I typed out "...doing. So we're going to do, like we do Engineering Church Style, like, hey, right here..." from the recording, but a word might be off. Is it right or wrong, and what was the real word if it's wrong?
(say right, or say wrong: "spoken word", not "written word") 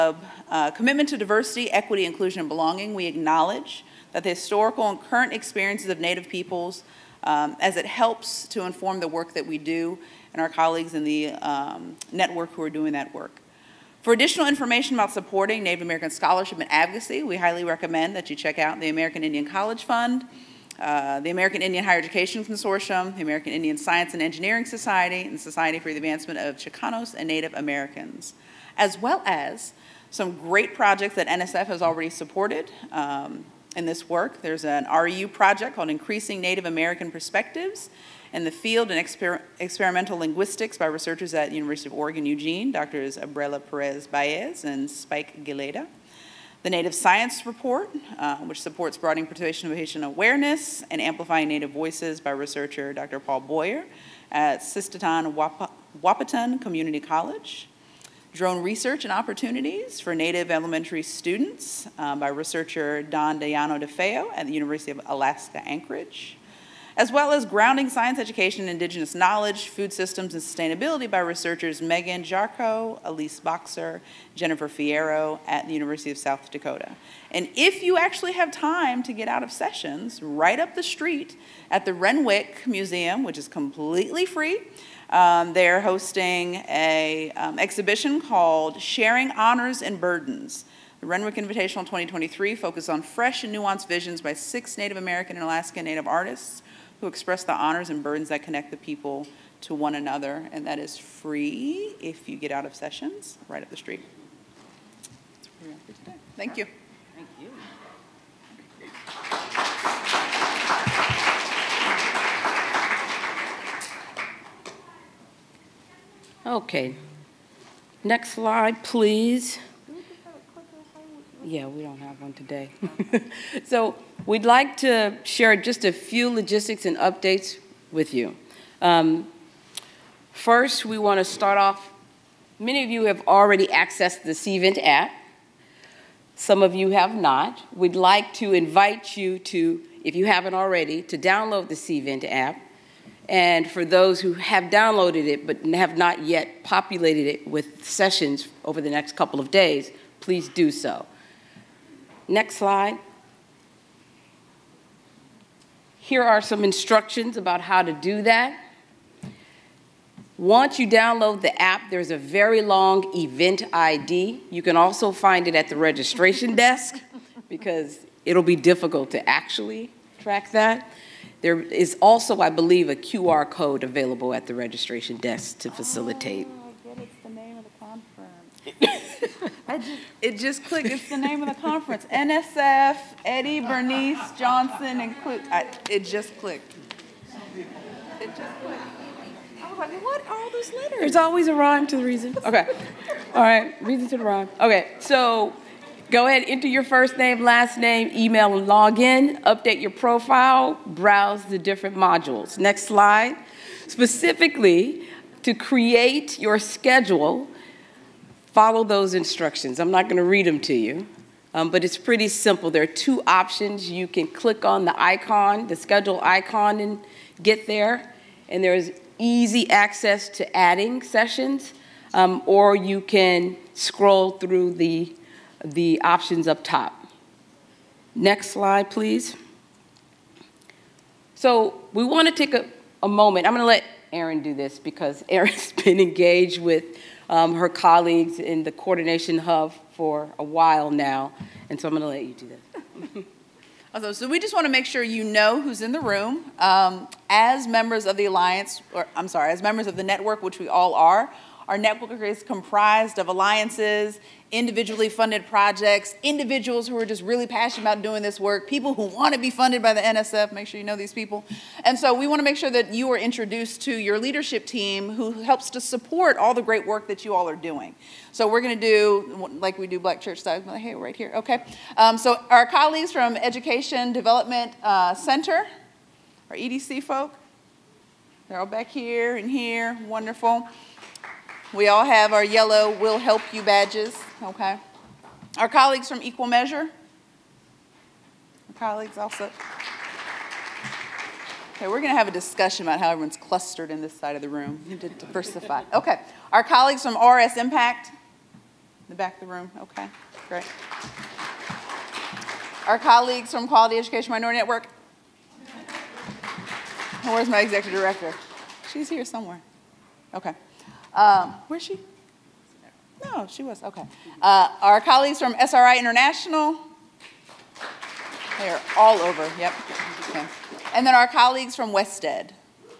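wrong: "Black", not "Engineering".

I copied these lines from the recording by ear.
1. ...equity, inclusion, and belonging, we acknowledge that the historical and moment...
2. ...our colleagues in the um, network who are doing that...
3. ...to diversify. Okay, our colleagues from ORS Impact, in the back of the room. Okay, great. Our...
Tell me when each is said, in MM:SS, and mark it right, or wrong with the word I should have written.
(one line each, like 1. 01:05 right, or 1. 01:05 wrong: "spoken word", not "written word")
1. 00:01 wrong: "current", not "moment"
2. 00:10 right
3. 04:55 right.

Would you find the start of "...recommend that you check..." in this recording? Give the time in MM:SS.
00:17.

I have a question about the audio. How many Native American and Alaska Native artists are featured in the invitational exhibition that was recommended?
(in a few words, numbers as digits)
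6.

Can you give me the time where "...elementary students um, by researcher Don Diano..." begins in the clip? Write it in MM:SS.
01:00.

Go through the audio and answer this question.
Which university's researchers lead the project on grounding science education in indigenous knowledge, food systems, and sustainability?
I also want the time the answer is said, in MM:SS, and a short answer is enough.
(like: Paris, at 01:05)
University of South Dakota, at 01:15.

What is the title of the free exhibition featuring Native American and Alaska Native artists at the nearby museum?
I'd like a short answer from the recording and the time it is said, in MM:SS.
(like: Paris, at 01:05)
Sharing Honors and Burdens, at 01:28.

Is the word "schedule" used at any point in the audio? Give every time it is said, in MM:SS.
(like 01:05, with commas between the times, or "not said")
03:26, 03:35.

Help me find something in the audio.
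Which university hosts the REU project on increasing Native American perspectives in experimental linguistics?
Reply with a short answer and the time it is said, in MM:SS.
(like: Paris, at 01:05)
University of Oregon, at 00:41.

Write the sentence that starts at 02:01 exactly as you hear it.
Yeah, we don't have one today.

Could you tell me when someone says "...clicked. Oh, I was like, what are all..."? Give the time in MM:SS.
03:08.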